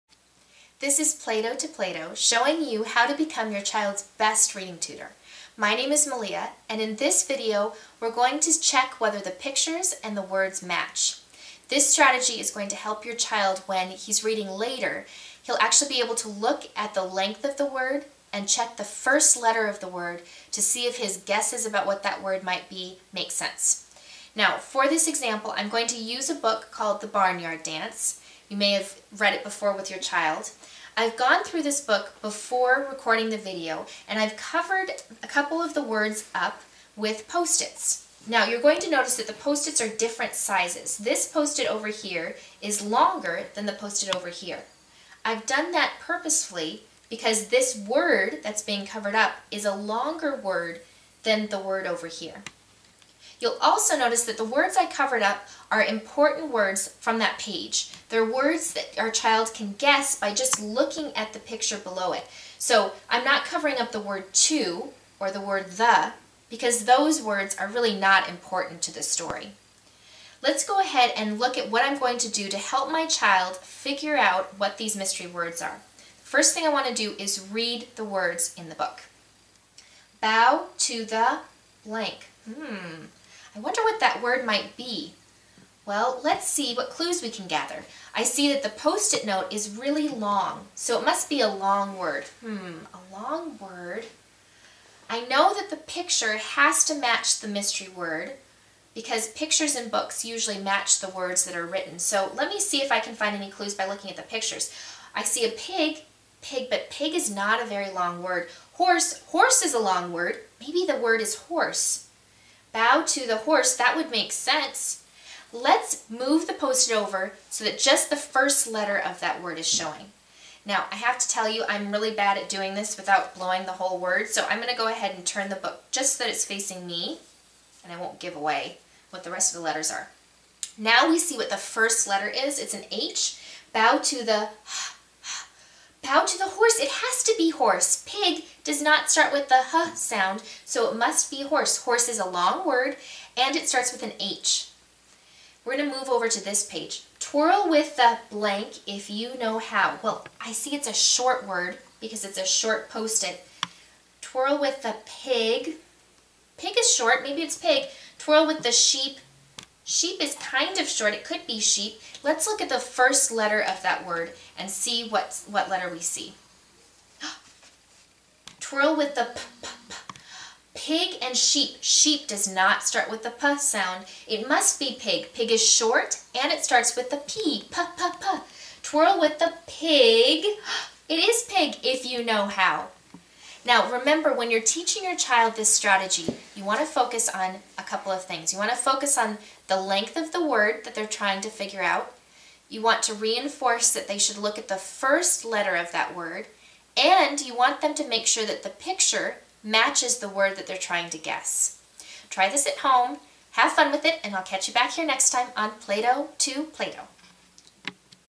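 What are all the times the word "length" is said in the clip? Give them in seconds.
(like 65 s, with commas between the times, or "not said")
17 s, 189 s.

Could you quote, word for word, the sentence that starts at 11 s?
This strategy is going to help your child when he's reading later.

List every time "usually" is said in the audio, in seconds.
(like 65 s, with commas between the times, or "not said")
100 s.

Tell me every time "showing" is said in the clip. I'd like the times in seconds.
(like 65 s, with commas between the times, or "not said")
2 s, 119 s.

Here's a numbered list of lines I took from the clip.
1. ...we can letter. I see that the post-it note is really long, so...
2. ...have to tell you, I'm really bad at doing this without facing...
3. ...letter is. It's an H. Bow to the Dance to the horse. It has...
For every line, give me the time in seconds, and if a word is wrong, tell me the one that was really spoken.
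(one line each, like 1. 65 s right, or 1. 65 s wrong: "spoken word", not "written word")
1. 87 s wrong: "gather", not "letter"
2. 120 s wrong: "blowing", not "facing"
3. 132 s wrong: "Bow", not "Dance".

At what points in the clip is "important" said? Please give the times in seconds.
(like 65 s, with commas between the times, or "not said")
55 s, 68 s.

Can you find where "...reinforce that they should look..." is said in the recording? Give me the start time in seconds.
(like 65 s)
193 s.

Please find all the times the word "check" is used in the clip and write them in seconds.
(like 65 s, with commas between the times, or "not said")
8 s, 18 s.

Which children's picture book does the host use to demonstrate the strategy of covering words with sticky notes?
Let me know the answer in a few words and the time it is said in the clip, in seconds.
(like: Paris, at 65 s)
The Barnyard Dance, at 27 s.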